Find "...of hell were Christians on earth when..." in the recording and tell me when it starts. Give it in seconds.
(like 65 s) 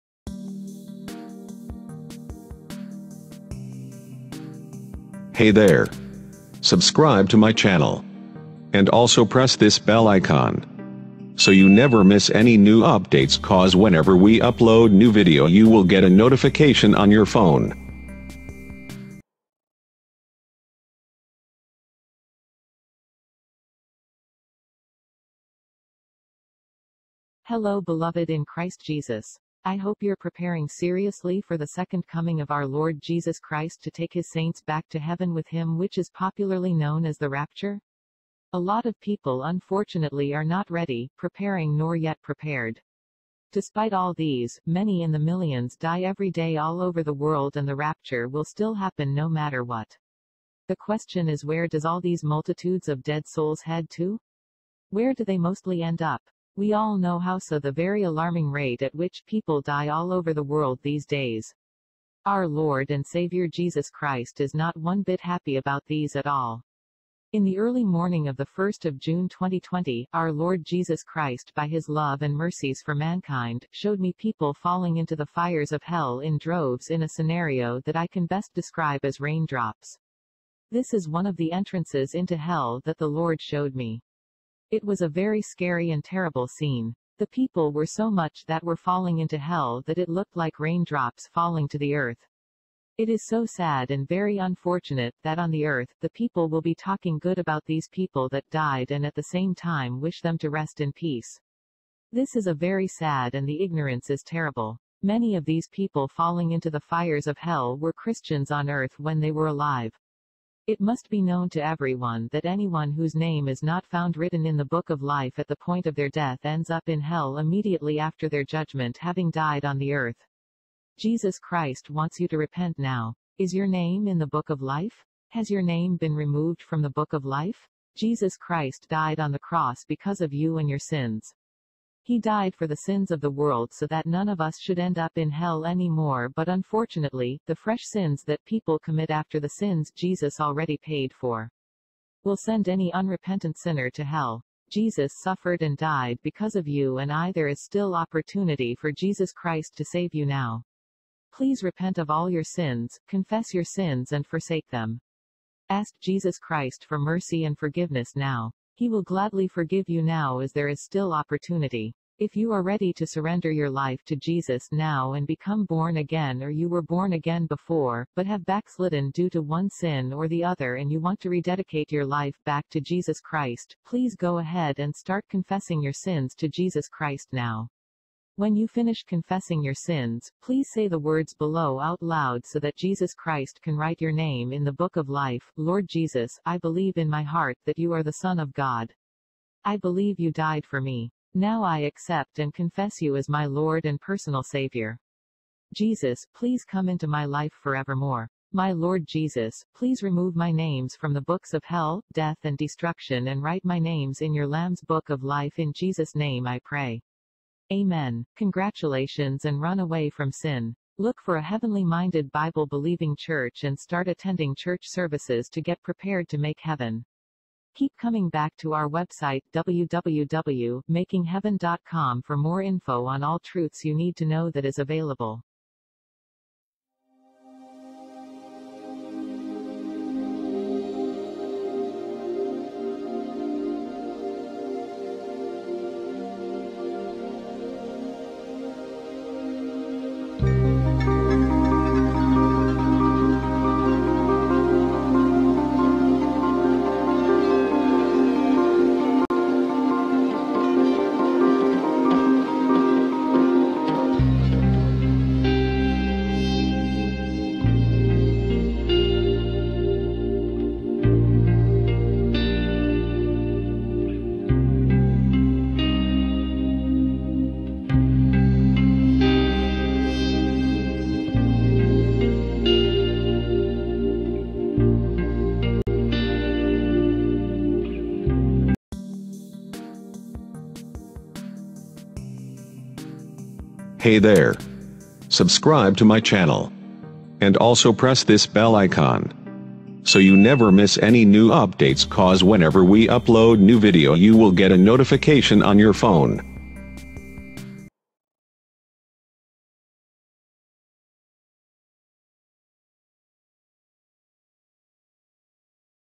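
107 s.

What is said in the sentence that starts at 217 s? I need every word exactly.
Keep coming back to our website www.makingheaven.com for more info on all truths you need to know that is available.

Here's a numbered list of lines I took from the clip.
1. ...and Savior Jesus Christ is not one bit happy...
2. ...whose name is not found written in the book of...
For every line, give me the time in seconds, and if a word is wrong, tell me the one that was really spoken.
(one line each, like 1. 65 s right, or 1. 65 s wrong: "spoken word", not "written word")
1. 62 s right
2. 112 s right.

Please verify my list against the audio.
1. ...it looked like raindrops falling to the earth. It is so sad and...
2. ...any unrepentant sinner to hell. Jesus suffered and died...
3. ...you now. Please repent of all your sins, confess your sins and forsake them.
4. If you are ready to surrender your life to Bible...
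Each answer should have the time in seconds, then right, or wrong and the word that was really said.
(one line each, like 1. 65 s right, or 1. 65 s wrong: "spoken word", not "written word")
1. 89 s right
2. 142 s right
3. 150 s right
4. 162 s wrong: "Jesus", not "Bible".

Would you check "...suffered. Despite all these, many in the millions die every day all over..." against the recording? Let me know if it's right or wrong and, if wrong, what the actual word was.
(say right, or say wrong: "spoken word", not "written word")
wrong: "prepared", not "suffered".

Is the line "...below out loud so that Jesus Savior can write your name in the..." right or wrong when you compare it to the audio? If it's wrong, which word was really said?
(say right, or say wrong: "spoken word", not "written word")
wrong: "Christ", not "Savior".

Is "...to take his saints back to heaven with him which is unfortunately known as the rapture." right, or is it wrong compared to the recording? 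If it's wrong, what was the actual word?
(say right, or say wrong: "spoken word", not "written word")
wrong: "popularly", not "unfortunately".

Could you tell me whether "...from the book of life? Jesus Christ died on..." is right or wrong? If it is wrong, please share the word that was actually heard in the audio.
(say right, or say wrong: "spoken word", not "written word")
right.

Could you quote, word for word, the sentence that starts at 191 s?
Now I accept and confess you as my Lord and personal Savior.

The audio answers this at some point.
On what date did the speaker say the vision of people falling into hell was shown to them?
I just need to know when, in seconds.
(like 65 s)
68 s.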